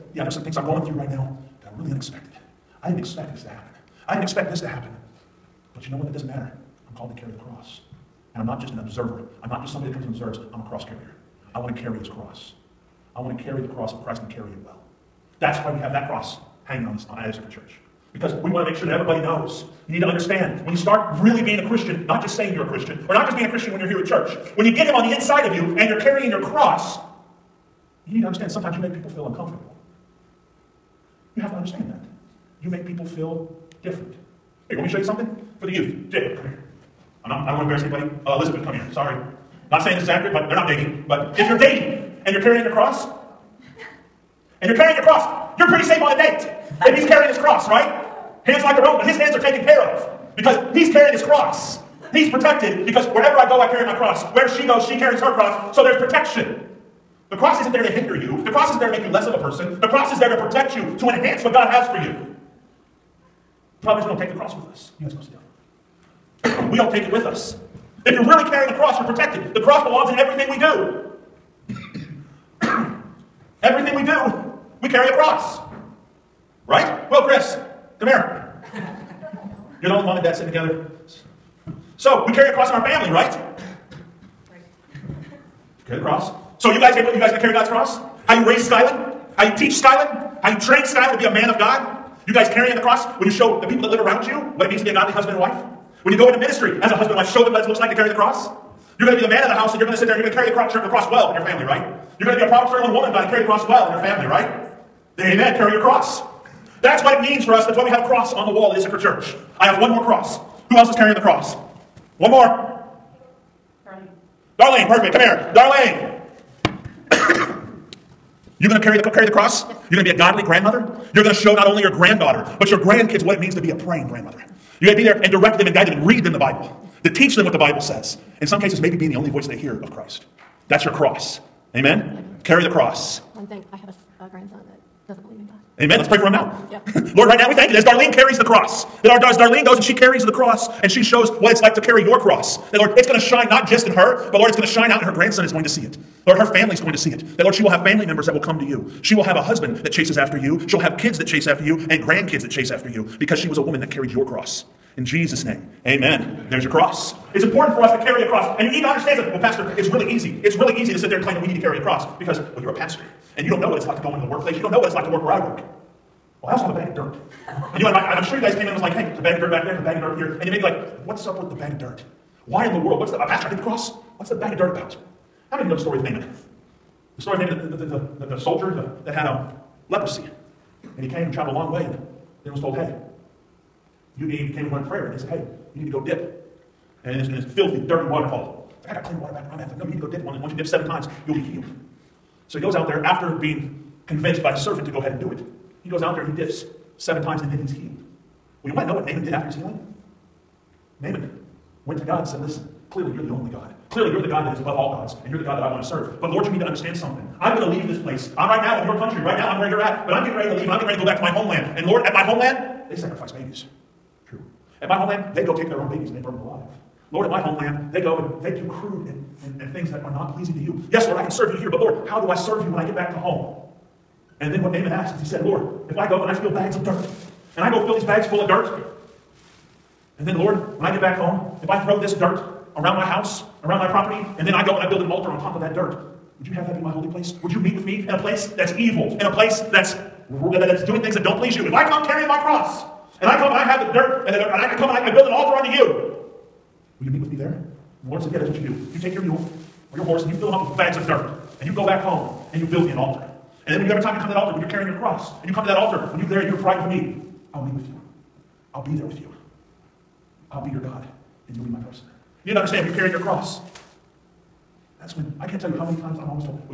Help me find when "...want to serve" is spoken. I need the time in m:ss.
3:25.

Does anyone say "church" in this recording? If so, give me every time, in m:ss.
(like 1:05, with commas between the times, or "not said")
0:17, 0:24, 1:48.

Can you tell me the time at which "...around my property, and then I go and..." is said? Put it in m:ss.
3:53.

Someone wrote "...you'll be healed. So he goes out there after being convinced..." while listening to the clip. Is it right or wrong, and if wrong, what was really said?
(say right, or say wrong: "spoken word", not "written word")
right.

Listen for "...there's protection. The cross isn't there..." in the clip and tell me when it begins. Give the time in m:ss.
0:55.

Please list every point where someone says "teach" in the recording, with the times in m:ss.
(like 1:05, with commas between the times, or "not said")
1:29, 2:07.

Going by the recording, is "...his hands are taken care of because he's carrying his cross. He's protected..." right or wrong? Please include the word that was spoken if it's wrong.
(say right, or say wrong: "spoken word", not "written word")
right.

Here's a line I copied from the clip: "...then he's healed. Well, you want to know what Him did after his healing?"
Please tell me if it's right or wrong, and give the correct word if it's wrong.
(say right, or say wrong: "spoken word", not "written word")
wrong: "Naaman", not "Him".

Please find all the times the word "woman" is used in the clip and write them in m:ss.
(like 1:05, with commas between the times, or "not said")
1:42, 2:33.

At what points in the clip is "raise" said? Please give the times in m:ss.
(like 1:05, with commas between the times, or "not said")
1:28.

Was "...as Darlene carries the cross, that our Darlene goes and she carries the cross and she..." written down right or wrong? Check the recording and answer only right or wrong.
right.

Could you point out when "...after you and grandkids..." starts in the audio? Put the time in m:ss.
2:31.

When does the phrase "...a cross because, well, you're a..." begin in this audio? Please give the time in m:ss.
2:41.